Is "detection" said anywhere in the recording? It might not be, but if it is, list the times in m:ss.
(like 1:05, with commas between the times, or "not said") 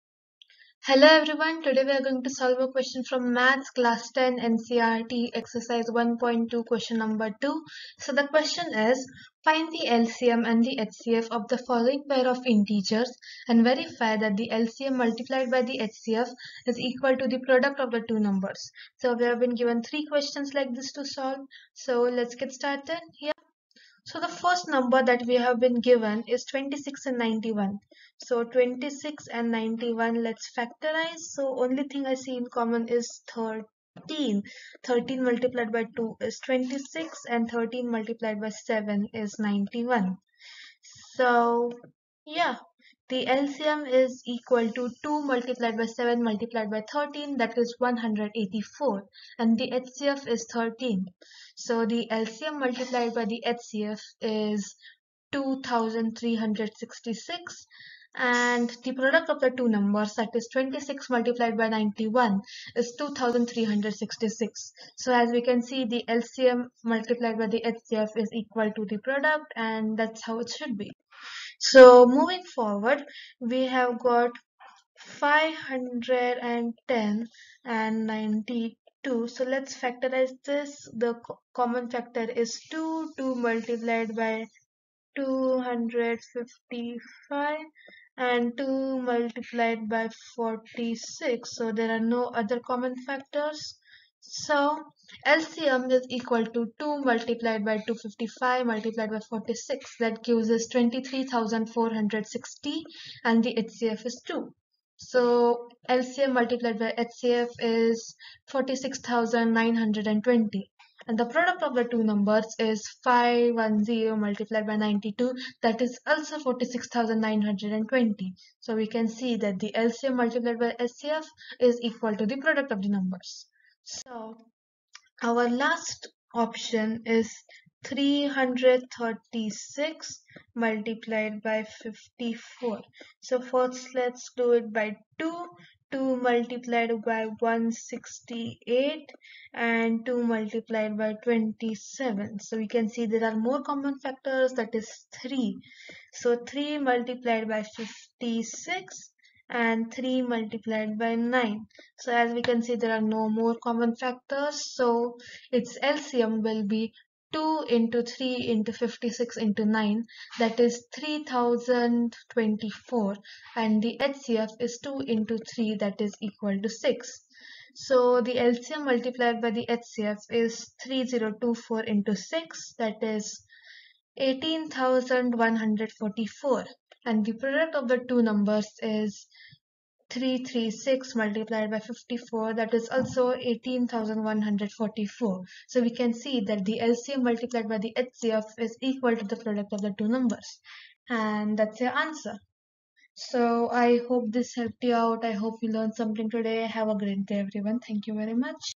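not said.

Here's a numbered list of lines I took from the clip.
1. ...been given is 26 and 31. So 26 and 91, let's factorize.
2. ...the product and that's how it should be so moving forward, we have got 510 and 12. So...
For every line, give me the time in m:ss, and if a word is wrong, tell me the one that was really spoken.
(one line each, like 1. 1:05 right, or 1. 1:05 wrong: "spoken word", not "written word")
1. 0:25 wrong: "91", not "31"
2. 1:08 wrong: "92", not "12".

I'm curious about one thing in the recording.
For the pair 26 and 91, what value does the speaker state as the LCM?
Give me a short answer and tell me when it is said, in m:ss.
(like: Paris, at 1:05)
184, at 0:47.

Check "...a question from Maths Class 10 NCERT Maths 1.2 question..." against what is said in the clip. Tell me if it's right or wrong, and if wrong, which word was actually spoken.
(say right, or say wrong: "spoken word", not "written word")
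wrong: "Exercise", not "Maths".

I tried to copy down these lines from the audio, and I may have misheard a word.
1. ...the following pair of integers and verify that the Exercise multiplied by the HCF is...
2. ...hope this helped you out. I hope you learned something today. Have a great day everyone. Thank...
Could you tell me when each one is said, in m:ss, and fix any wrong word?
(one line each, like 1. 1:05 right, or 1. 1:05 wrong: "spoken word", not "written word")
1. 0:11 wrong: "LCM", not "Exercise"
2. 3:14 right.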